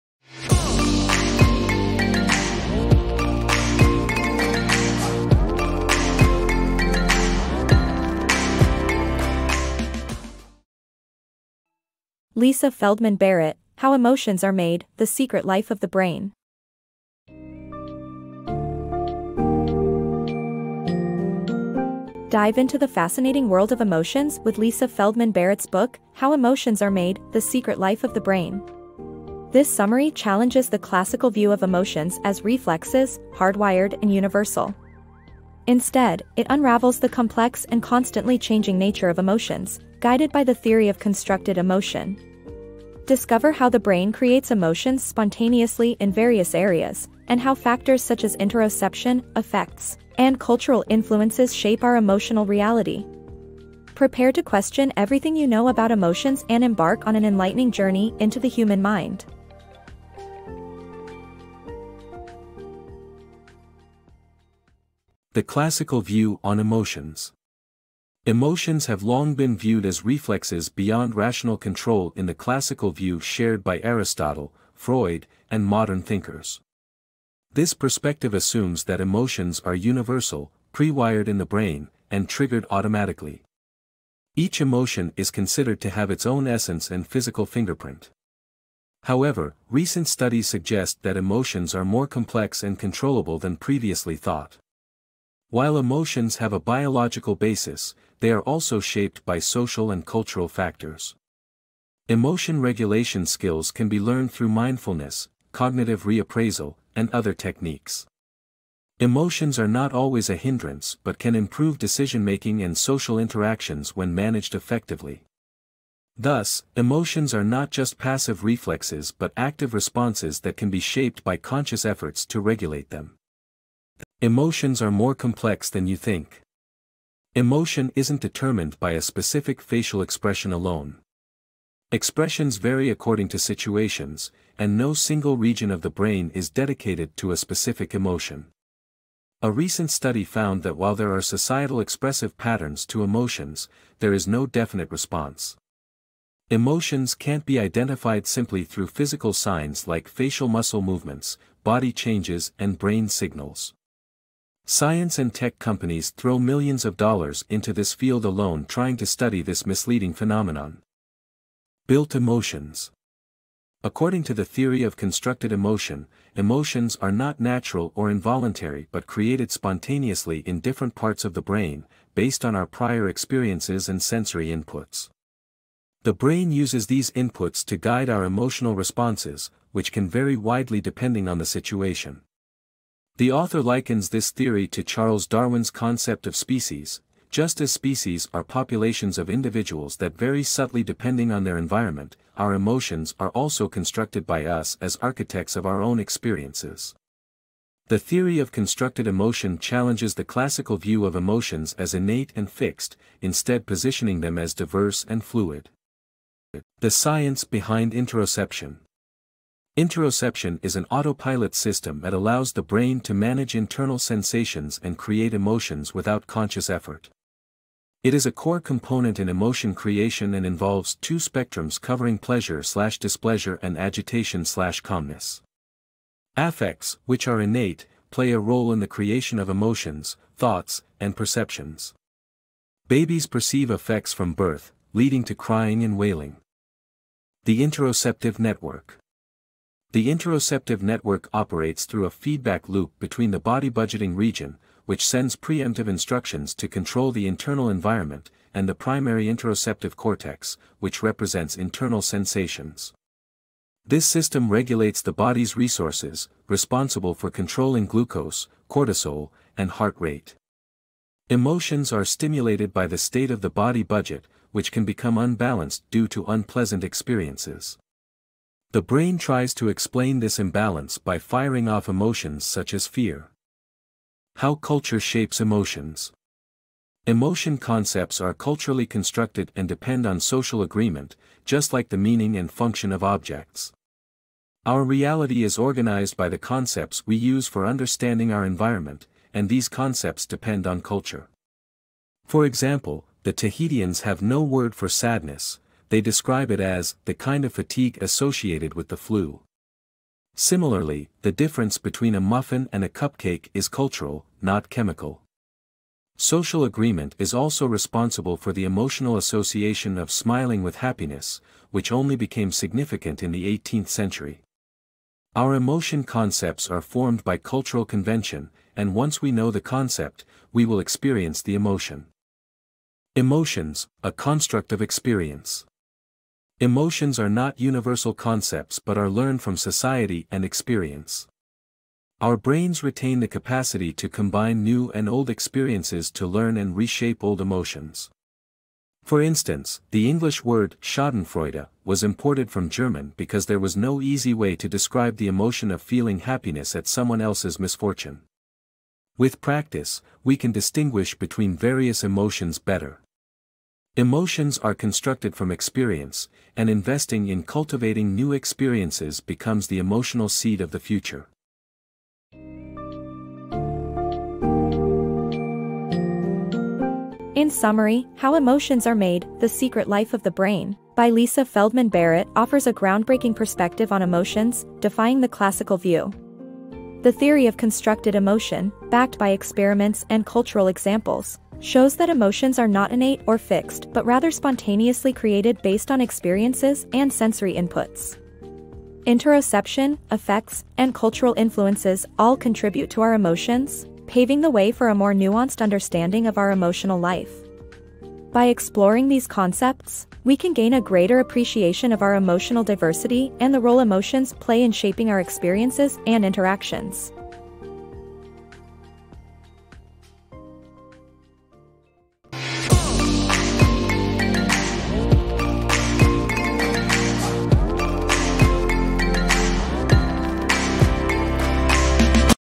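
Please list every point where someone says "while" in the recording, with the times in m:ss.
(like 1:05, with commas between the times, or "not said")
1:35, 2:20.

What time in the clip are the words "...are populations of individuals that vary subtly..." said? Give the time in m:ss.
3:08.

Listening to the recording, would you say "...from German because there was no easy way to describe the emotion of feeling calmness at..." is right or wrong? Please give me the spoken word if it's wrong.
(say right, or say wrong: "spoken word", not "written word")
wrong: "happiness", not "calmness".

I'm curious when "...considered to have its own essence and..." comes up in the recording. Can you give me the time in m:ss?
1:25.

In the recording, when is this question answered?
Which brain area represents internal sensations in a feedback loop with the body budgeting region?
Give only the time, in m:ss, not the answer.
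4:08.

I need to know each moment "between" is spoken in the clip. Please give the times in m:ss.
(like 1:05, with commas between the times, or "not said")
4:02, 5:01, 5:51.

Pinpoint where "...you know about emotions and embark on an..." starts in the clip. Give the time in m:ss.
0:55.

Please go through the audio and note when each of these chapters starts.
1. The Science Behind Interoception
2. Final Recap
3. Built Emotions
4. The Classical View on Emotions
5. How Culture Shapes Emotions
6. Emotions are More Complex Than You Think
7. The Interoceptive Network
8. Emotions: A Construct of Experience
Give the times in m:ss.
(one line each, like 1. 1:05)
1. 3:27
2. 6:02
3. 2:42
4. 1:06
5. 4:34
6. 2:04
7. 3:58
8. 5:23.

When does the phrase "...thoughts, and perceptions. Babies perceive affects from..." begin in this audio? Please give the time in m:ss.
3:50.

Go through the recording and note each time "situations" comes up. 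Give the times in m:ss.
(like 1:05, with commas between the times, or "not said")
2:13, 3:01.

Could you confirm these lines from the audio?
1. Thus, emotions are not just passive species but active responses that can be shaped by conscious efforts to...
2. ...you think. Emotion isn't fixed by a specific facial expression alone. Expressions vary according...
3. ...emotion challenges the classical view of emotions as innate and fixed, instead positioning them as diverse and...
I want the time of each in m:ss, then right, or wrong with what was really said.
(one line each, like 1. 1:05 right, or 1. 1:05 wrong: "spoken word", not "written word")
1. 1:56 wrong: "reflexes", not "species"
2. 2:05 wrong: "determined", not "fixed"
3. 3:19 right.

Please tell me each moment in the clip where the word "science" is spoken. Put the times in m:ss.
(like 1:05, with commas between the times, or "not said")
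2:34, 3:26.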